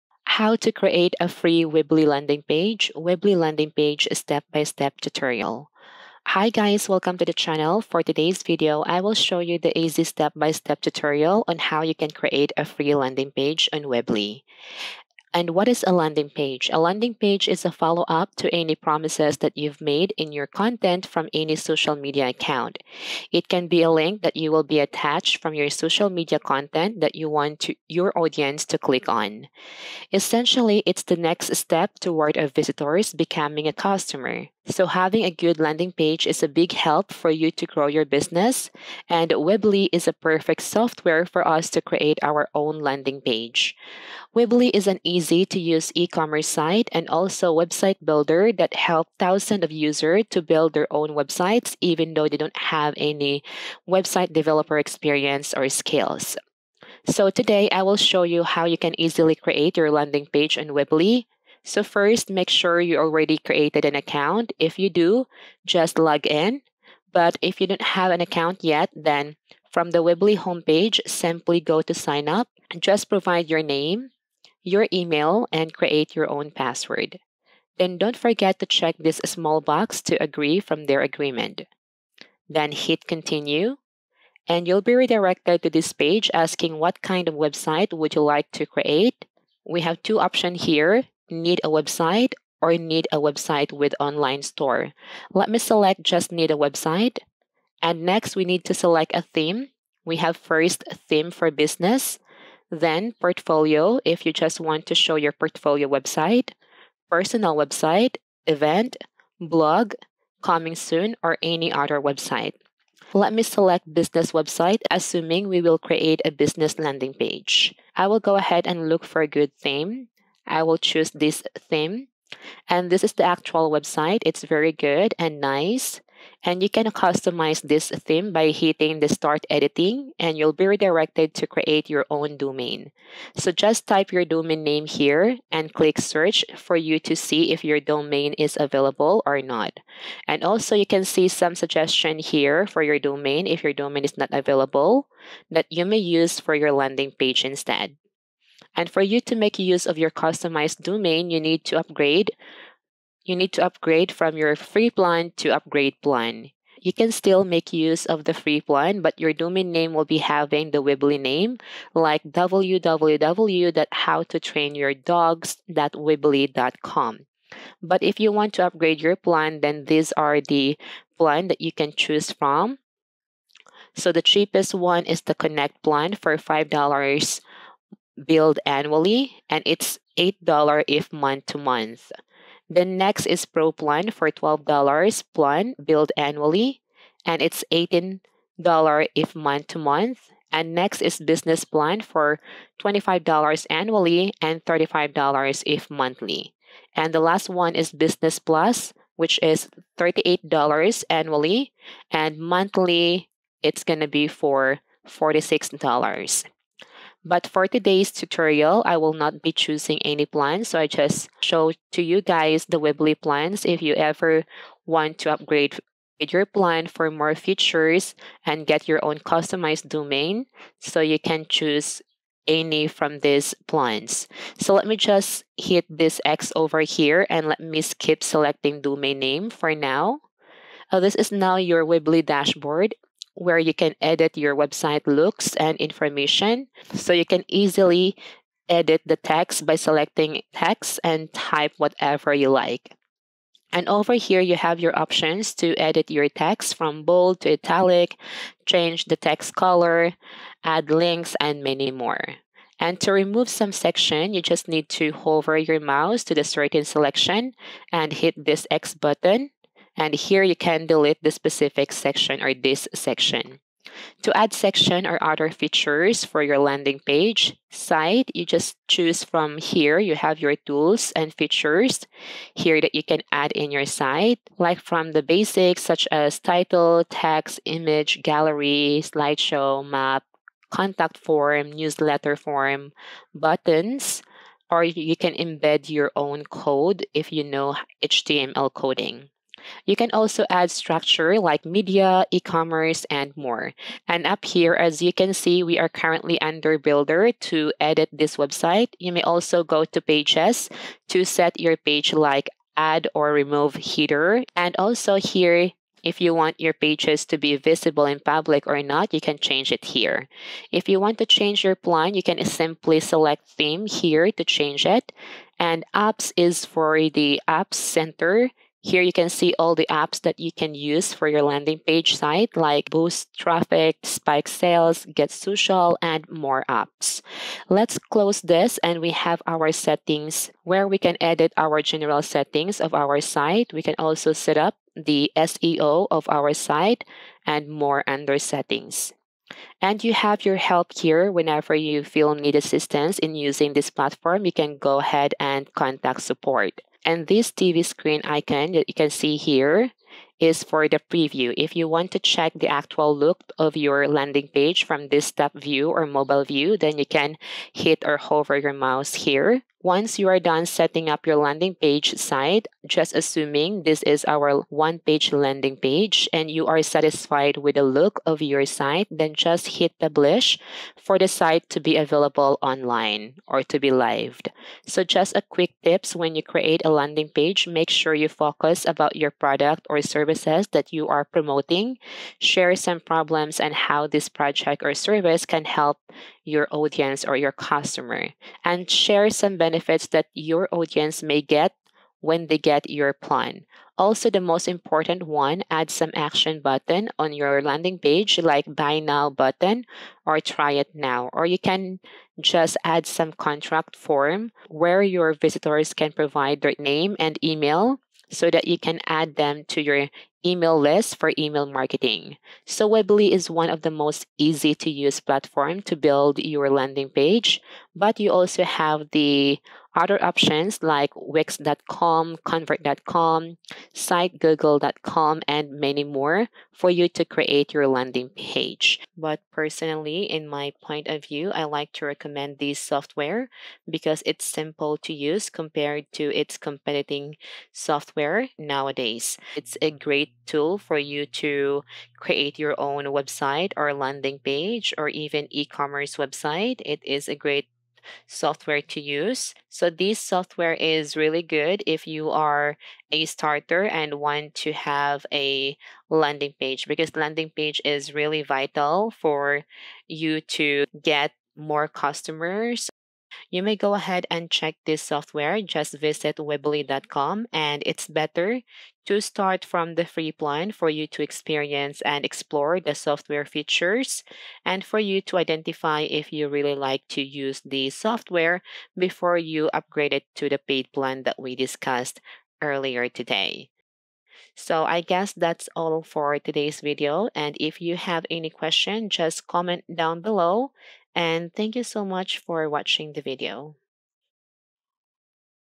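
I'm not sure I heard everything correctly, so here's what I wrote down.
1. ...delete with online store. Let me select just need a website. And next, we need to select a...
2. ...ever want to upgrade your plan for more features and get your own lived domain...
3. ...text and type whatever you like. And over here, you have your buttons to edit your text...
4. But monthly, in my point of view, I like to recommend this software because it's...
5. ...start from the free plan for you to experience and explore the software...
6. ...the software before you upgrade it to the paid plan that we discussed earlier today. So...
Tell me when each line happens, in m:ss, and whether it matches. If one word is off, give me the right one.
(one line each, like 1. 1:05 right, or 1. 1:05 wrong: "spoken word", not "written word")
1. 1:33 wrong: "website", not "delete"
2. 3:33 wrong: "customized", not "lived"
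3. 4:00 wrong: "options", not "buttons"
4. 7:09 wrong: "personally", not "monthly"
5. 7:49 right
6. 7:57 right.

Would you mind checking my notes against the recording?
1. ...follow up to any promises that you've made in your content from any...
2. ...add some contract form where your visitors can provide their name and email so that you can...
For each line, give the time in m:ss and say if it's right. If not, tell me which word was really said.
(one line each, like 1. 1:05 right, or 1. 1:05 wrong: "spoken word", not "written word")
1. 0:17 right
2. 6:42 right.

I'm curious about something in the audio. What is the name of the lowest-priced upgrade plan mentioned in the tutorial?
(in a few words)
Connect.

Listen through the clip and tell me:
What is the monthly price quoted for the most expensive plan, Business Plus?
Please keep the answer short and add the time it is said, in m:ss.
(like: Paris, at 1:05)
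$46, at 3:25.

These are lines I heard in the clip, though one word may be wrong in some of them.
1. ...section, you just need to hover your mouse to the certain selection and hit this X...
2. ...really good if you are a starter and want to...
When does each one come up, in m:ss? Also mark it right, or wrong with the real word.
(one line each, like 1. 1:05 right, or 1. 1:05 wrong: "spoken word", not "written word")
1. 4:13 right
2. 7:31 right.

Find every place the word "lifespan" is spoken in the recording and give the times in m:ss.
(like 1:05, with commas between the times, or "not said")
not said.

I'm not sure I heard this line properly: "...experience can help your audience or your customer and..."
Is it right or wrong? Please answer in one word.
wrong.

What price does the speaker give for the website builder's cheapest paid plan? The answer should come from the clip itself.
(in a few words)
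$5.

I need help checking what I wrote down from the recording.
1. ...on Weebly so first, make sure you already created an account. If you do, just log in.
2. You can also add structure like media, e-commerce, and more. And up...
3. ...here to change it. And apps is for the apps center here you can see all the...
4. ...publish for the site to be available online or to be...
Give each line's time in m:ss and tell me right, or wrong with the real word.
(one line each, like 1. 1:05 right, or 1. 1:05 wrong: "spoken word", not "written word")
1. 1:00 right
2. 4:49 right
3. 5:13 right
4. 6:09 right.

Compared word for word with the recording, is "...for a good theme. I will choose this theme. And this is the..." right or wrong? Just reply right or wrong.
right.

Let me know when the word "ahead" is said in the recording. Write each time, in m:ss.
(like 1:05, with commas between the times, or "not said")
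1:58, 5:44, 7:43.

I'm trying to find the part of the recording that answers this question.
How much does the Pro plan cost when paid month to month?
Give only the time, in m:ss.
3:07.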